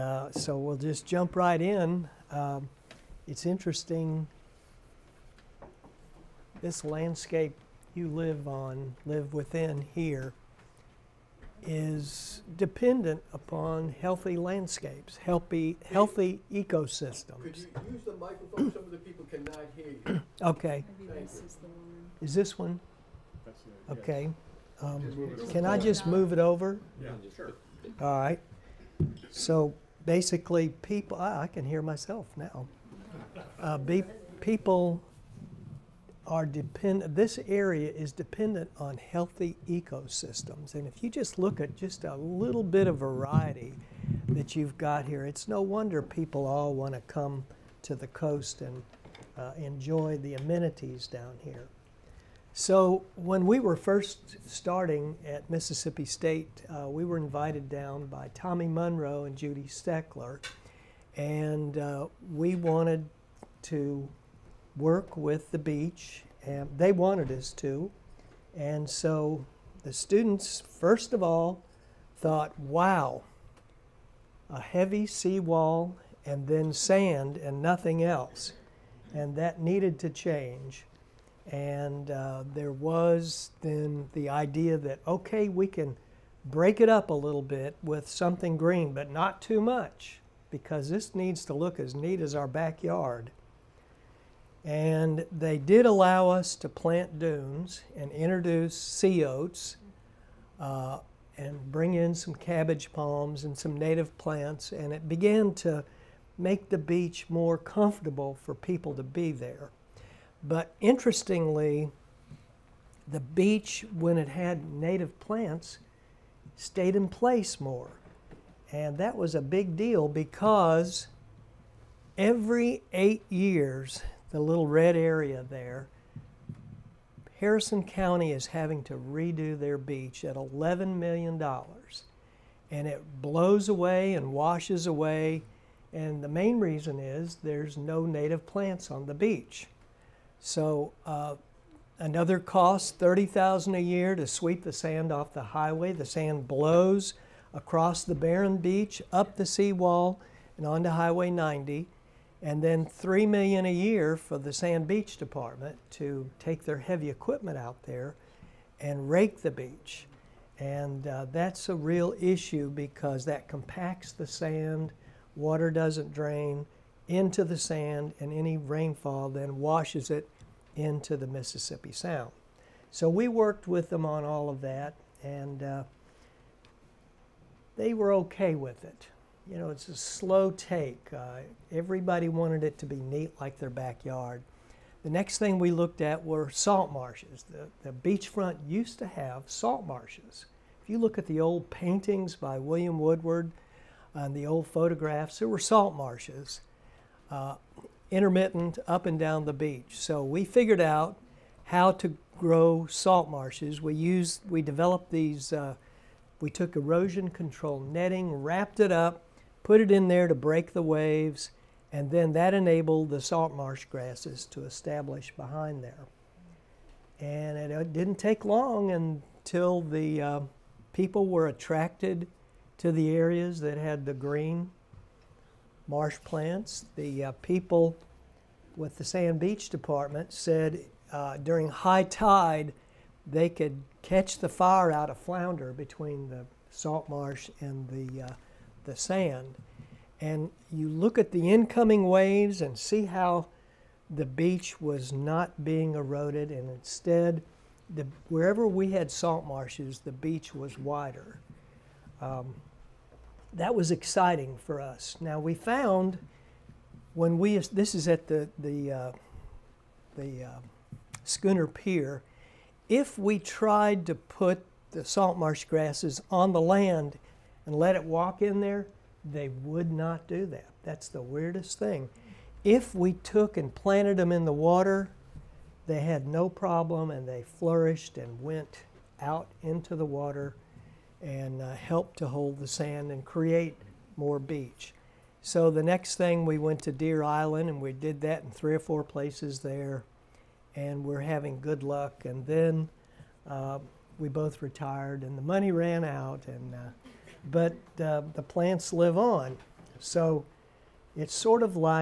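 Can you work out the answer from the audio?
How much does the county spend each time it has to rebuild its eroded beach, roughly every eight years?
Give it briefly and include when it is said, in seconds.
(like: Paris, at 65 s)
$11 million, at 130 s.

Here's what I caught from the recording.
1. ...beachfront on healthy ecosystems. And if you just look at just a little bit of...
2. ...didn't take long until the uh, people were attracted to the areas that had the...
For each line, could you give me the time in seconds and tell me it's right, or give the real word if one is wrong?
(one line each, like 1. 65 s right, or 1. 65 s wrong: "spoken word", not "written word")
1. 38 s wrong: "dependent", not "beachfront"
2. 217 s right.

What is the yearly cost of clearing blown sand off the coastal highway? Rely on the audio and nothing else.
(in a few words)
30000.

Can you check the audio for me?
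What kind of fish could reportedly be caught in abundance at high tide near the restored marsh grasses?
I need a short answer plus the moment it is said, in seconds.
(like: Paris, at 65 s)
flounder, at 235 s.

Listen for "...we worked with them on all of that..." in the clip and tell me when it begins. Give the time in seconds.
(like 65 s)
173 s.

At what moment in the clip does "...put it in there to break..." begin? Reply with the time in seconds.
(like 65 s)
209 s.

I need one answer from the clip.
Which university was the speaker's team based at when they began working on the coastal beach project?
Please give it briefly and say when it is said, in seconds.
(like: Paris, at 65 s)
Mississippi State, at 55 s.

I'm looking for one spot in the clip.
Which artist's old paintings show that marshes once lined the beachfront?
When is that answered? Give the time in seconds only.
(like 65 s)
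192 s.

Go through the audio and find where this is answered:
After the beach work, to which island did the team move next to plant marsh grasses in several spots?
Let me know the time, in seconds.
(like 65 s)
286 s.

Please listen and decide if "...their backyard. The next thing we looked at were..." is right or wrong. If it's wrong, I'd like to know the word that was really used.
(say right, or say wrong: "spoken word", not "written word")
right.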